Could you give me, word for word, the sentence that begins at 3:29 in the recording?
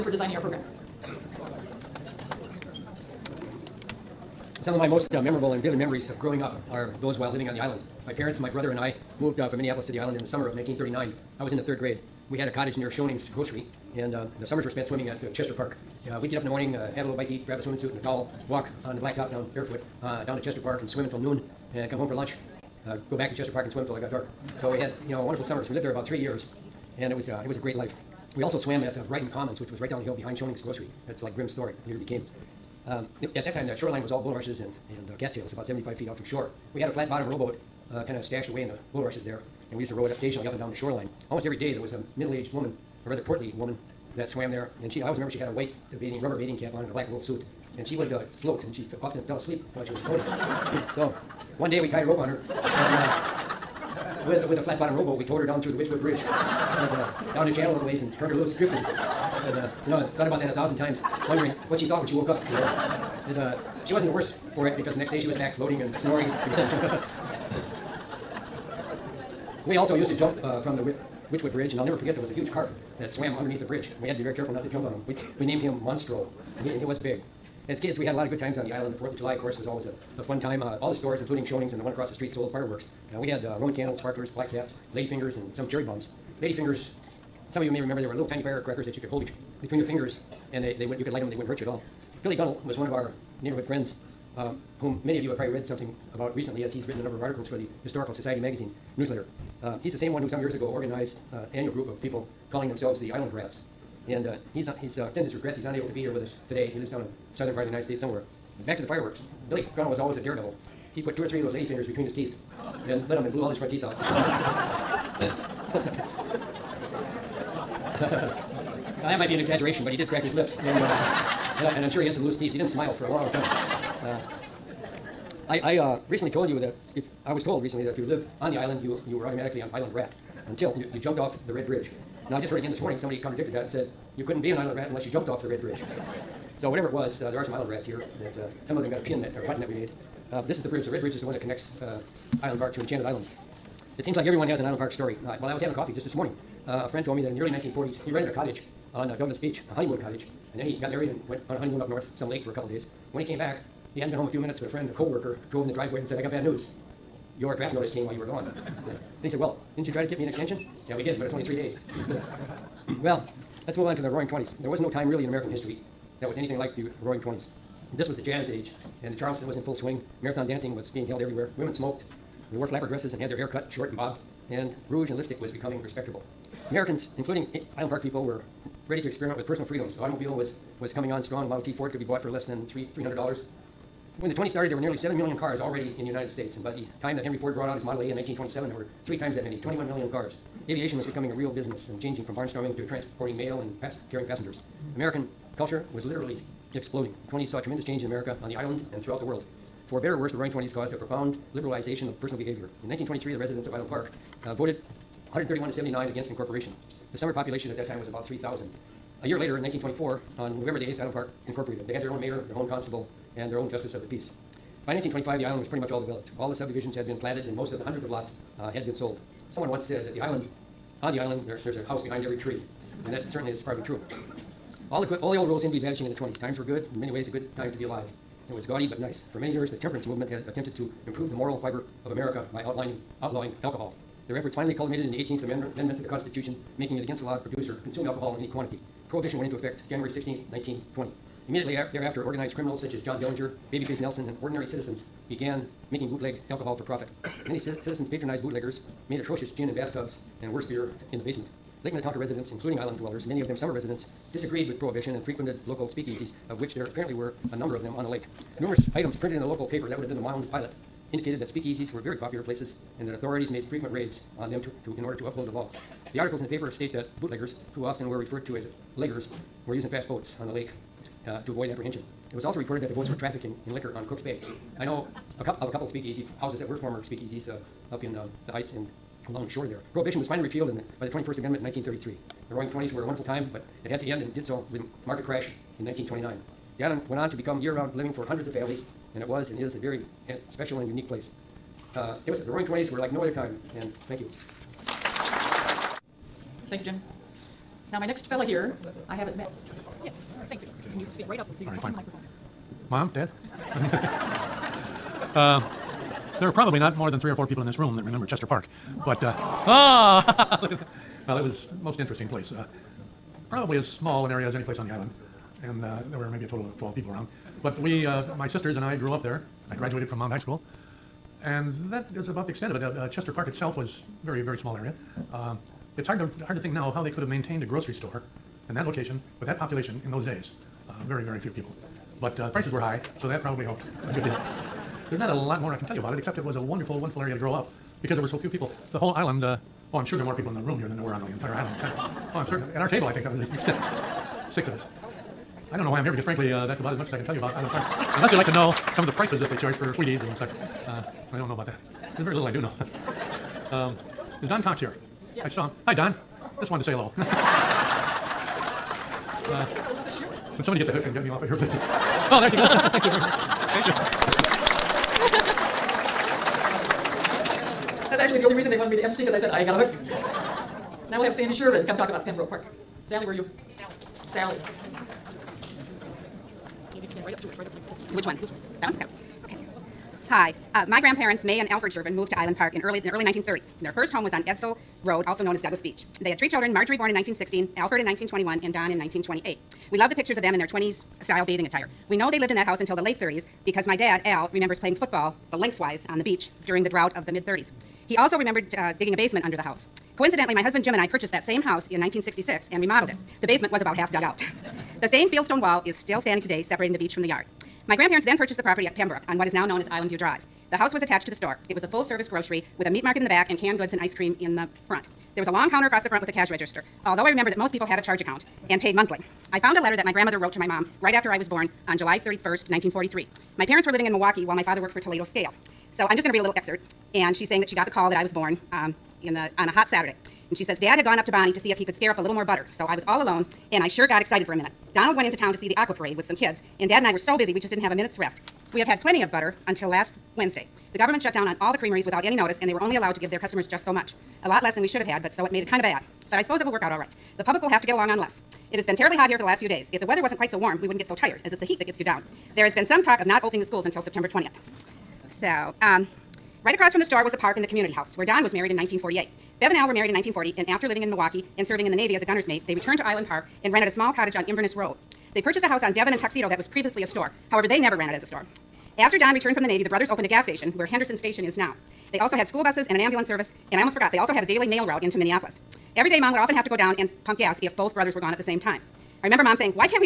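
A year later, in 1924, on November the 8th, Island Park incorporated.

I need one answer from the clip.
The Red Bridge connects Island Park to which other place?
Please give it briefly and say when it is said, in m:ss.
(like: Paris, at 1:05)
Enchanted Island, at 2:22.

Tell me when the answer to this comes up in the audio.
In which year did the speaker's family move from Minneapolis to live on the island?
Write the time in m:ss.
0:10.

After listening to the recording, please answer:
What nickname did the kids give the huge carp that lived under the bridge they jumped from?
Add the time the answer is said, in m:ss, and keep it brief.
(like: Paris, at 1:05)
Monstro, at 1:15.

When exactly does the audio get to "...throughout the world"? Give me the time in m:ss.
3:19.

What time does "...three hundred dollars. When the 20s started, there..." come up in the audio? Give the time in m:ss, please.
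3:02.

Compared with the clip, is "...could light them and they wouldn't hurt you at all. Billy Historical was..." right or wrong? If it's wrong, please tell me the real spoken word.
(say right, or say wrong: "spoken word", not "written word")
wrong: "Gunnell", not "Historical".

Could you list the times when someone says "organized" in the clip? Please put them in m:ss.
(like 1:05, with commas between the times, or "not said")
1:40, 4:02.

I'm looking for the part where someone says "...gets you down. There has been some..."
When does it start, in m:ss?
7:31.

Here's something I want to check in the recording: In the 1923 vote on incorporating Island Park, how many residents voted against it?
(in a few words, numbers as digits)
131.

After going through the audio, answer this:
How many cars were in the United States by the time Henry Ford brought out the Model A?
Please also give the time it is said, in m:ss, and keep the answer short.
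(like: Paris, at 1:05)
21 million, at 3:09.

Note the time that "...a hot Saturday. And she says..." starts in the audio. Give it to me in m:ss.
7:09.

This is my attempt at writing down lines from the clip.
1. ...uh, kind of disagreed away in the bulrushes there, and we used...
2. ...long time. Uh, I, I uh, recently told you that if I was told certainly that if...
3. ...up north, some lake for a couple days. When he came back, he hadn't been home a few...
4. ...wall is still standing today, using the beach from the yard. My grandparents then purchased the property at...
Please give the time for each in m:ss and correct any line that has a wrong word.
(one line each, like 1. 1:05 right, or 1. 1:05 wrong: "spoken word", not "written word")
1. 0:37 wrong: "stashed", not "disagreed"
2. 2:03 wrong: "recently", not "certainly"
3. 2:31 right
4. 6:45 wrong: "separating", not "using".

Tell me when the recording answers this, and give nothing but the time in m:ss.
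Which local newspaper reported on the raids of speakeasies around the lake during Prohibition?
4:20.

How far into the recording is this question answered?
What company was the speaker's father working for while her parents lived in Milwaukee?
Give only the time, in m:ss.
7:04.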